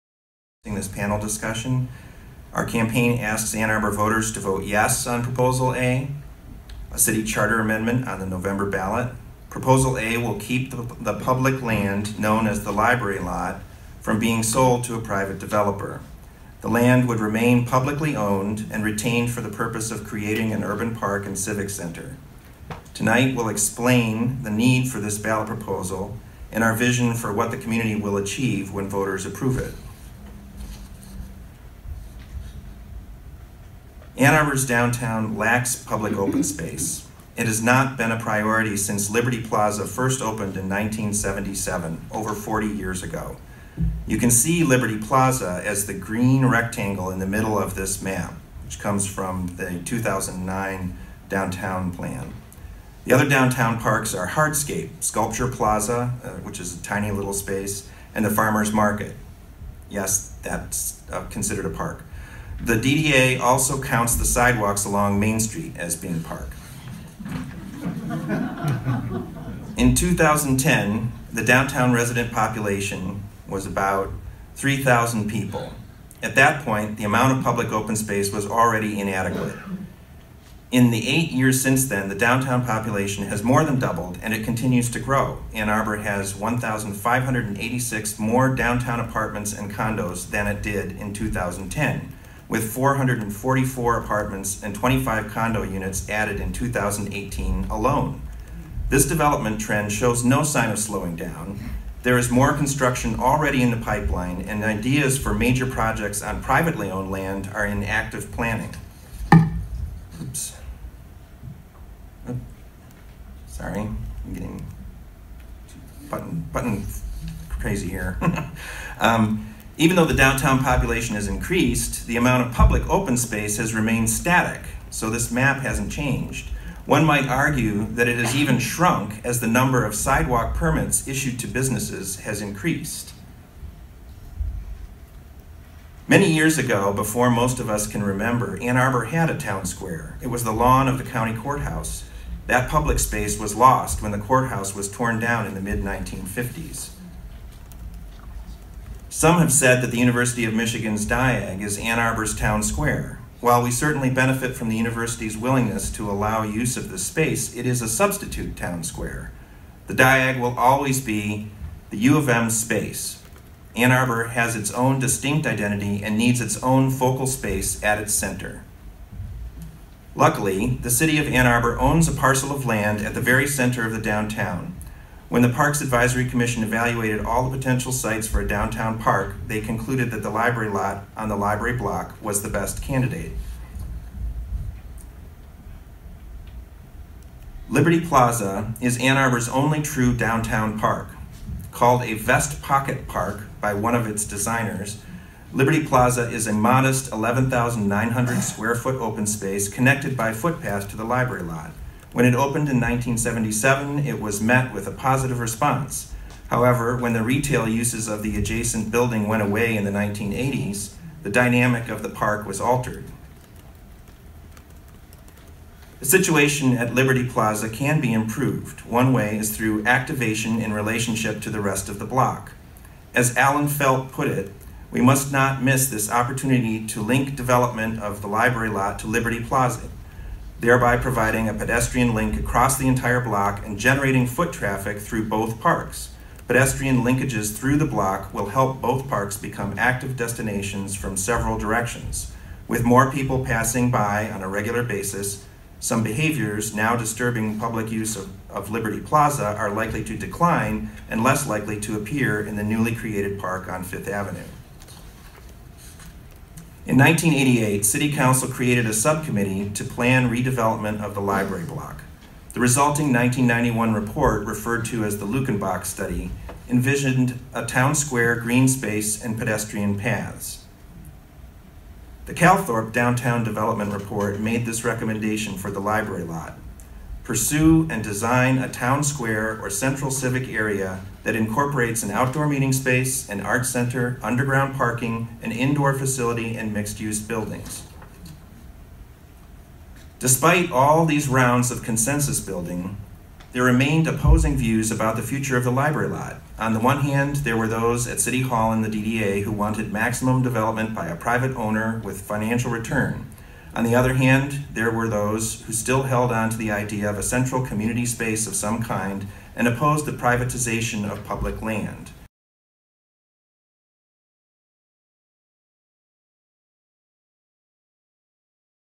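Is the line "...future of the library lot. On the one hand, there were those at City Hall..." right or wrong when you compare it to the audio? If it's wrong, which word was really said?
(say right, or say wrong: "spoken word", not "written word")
right.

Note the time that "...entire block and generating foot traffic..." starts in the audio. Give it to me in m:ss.
3:52.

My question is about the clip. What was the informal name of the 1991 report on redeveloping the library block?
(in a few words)
Luckenbach Study.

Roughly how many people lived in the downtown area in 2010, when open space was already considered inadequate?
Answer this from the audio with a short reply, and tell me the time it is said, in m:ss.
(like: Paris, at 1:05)
3,000, at 1:14.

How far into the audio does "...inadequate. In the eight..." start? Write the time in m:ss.
1:18.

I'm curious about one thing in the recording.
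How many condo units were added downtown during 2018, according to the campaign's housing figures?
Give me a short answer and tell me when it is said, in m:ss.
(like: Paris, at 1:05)
25, at 1:34.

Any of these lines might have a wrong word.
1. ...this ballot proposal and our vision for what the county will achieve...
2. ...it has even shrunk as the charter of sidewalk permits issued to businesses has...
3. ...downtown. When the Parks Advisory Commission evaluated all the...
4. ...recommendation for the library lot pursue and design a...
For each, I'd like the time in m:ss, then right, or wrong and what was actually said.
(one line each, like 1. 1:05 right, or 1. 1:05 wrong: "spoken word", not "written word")
1. 0:24 wrong: "community", not "county"
2. 2:08 wrong: "number", not "charter"
3. 2:54 right
4. 4:34 right.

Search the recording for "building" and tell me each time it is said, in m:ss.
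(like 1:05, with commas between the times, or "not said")
3:28, 4:47, 4:52.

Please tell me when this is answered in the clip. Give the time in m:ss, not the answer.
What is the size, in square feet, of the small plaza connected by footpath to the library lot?
3:17.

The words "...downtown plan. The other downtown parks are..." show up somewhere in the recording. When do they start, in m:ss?
0:51.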